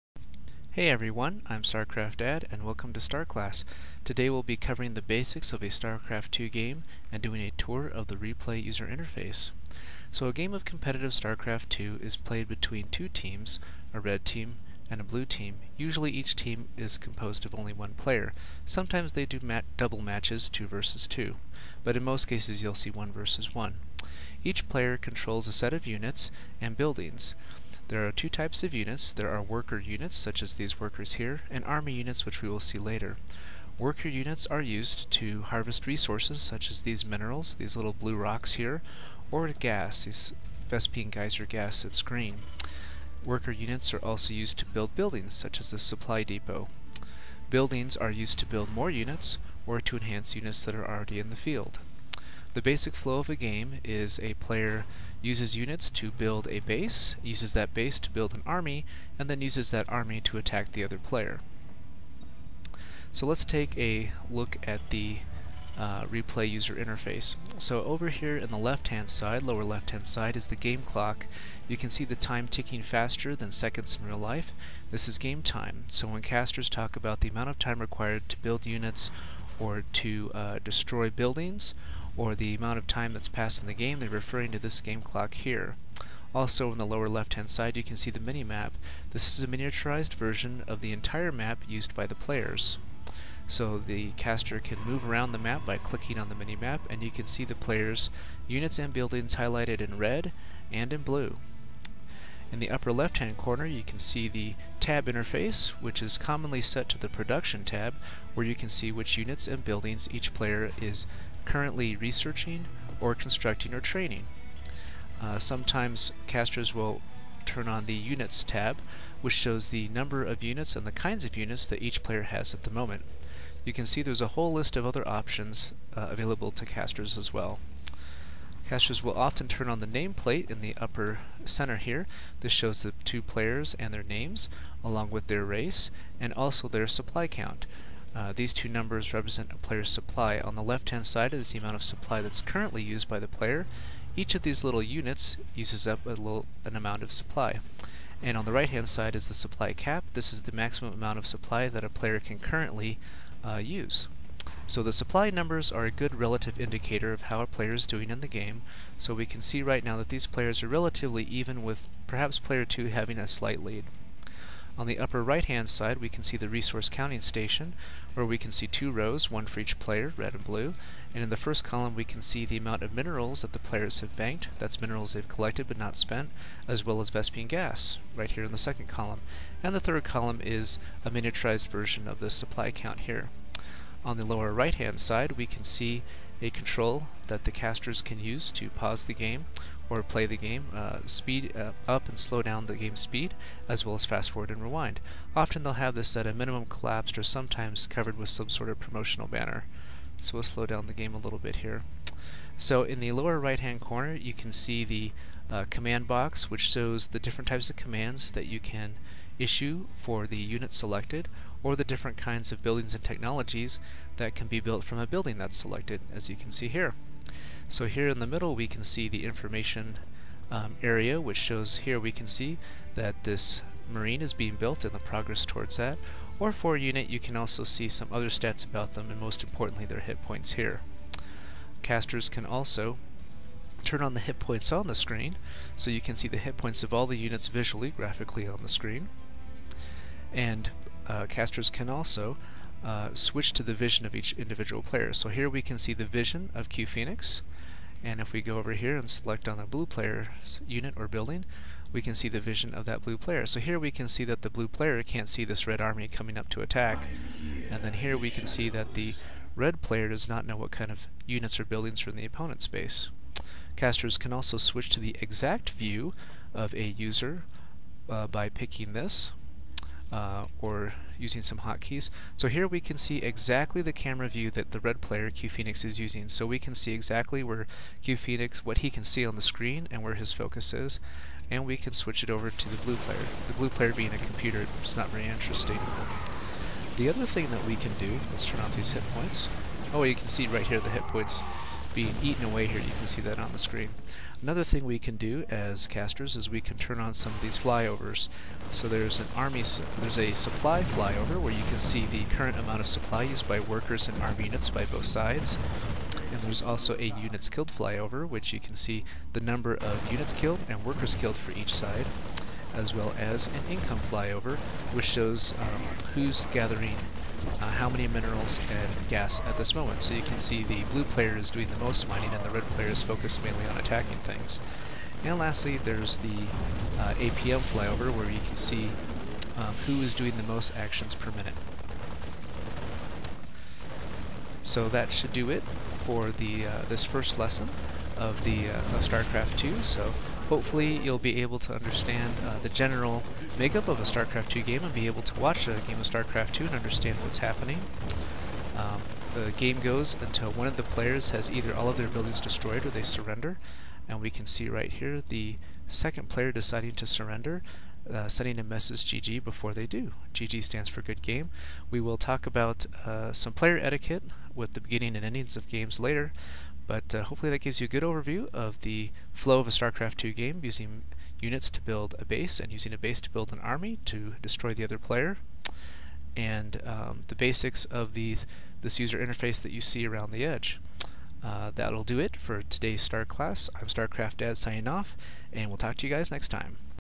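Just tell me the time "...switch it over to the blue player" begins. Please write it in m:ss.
4:41.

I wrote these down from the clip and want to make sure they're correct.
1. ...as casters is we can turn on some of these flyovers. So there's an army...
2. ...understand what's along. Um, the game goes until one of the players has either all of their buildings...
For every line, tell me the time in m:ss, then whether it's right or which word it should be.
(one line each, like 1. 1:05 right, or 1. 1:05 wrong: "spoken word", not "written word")
1. 4:55 right
2. 5:46 wrong: "happening", not "along".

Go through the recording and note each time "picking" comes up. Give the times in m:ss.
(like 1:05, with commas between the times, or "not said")
4:28.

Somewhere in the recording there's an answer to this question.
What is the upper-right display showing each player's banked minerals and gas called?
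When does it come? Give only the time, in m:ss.
2:46.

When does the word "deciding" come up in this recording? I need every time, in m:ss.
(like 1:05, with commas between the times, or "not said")
5:56.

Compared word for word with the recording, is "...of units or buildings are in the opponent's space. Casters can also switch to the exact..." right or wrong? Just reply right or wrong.
right.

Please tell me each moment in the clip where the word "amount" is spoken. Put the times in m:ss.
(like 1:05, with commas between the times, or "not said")
1:17, 1:22, 2:21, 2:26, 2:30, 2:52, 5:02.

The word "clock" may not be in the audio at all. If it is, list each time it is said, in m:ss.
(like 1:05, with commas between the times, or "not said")
1:10, 1:25.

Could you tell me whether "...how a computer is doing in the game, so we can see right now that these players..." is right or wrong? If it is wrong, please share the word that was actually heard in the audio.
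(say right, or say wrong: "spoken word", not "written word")
wrong: "player", not "computer".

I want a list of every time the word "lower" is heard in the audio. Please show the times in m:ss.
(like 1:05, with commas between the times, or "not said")
1:09, 1:26, 3:04, 3:23.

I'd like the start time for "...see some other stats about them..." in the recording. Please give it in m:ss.
3:47.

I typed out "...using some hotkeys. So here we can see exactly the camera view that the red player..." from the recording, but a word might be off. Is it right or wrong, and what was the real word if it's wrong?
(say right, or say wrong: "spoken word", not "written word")
right.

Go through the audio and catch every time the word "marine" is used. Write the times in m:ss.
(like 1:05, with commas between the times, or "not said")
3:43.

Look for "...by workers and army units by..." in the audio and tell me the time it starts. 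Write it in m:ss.
5:03.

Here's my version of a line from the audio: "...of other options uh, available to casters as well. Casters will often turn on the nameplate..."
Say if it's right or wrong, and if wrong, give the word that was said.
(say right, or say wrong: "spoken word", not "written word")
right.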